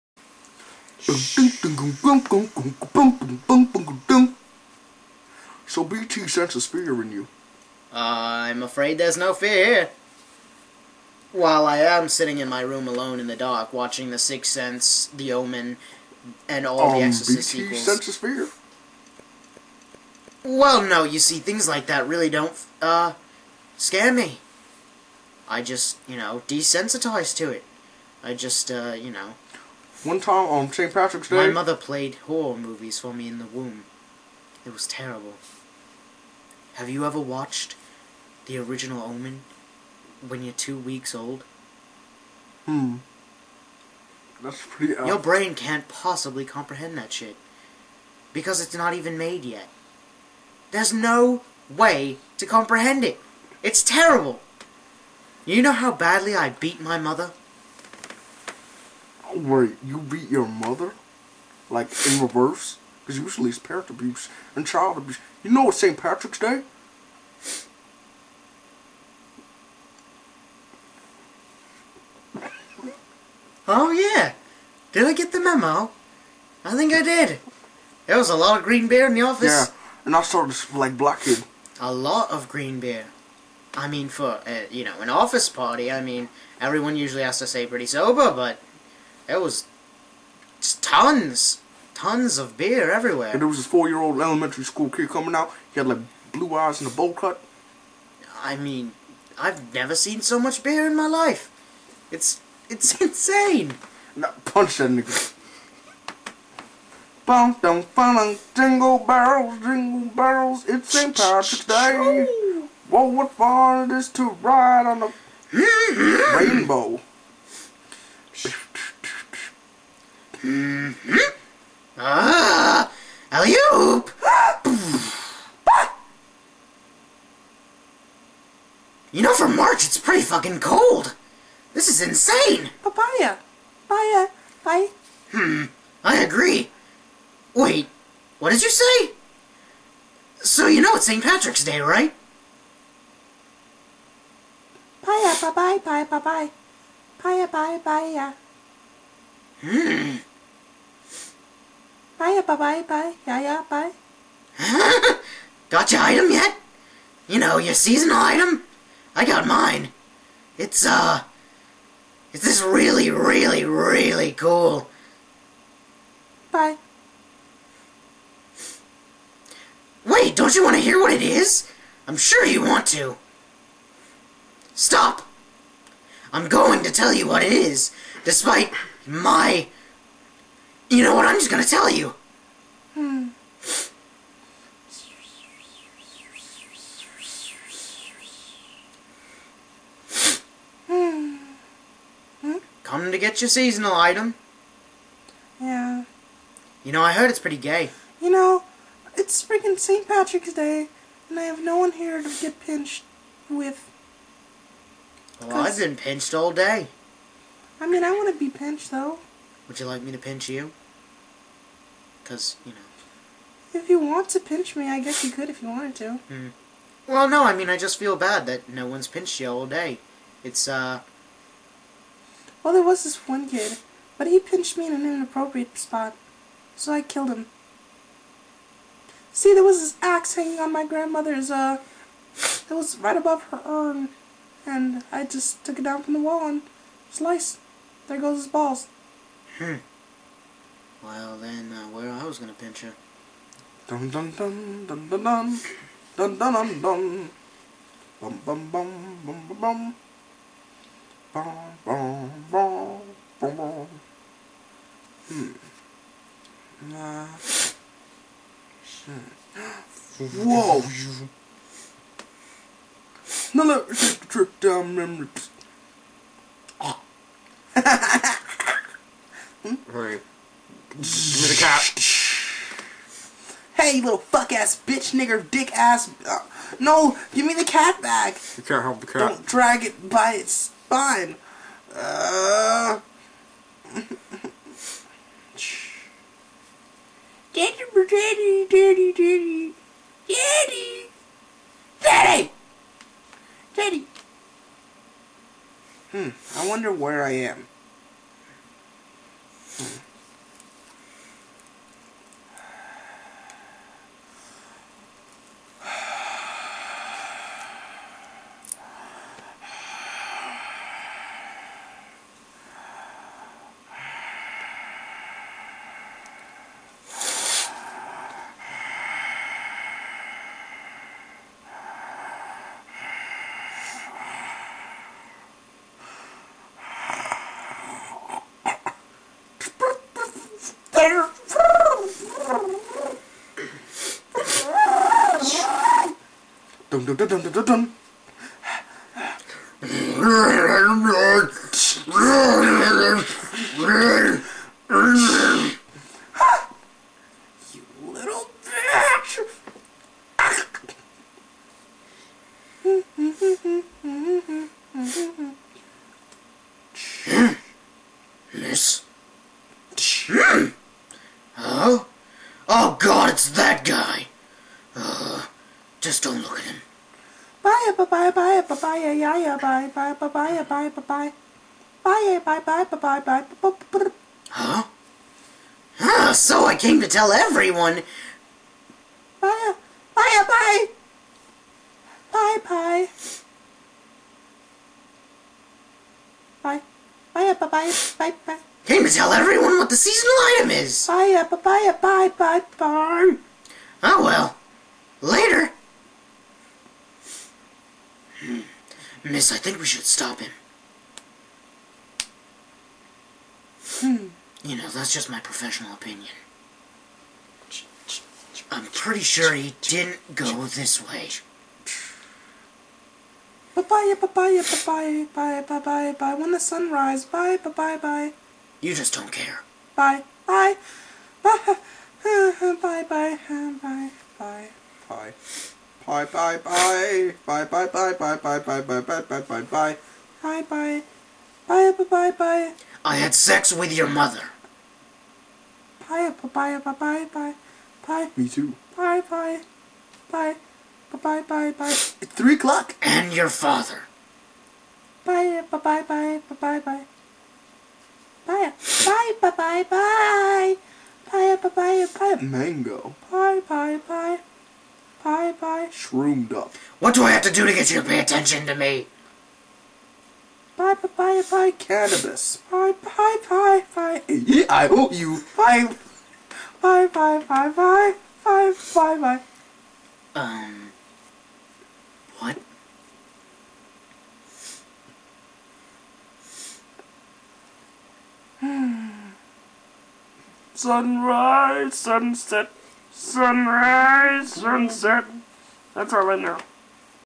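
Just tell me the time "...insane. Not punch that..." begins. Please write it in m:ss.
1:43.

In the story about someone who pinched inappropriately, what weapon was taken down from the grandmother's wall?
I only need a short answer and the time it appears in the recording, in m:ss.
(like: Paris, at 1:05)
Axe, at 3:50.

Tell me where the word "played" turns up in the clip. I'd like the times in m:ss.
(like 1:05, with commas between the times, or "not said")
0:31.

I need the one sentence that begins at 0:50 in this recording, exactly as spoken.
There's no way to comprehend it.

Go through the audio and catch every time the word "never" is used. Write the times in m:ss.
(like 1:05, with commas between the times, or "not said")
1:39.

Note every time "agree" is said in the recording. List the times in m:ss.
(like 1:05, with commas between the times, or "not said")
2:16.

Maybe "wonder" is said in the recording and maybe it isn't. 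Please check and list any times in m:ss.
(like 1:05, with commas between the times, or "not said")
4:56.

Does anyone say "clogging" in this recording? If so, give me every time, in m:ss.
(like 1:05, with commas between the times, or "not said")
not said.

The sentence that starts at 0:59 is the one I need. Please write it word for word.
where you beat your mother, like in reverse, because usually it's parent abuse and child abuse.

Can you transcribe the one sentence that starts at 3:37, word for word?
Well, no, I mean, I just feel bad that no one's pinched you all day.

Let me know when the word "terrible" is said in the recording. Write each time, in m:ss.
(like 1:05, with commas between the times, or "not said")
0:34, 0:53.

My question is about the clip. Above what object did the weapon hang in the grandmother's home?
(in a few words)
Her urn.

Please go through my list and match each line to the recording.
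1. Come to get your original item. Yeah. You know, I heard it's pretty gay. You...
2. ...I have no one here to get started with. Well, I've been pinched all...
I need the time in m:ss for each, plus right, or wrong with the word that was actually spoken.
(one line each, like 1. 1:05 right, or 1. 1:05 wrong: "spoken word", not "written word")
1. 3:12 wrong: "seasonal", not "original"
2. 3:21 wrong: "pinched", not "started".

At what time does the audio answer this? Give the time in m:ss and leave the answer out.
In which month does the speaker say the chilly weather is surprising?
2:09.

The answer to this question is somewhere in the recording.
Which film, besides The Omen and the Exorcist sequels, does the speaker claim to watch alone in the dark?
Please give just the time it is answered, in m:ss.
0:14.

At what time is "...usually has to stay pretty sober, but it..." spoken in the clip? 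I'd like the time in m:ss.
1:26.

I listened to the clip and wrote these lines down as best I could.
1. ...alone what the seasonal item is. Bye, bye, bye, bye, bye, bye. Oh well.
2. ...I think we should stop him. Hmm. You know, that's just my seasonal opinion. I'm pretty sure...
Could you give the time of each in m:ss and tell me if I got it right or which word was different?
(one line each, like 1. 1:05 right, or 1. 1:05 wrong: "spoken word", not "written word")
1. 6:29 wrong: "everyone", not "alone"
2. 6:39 wrong: "professional", not "seasonal".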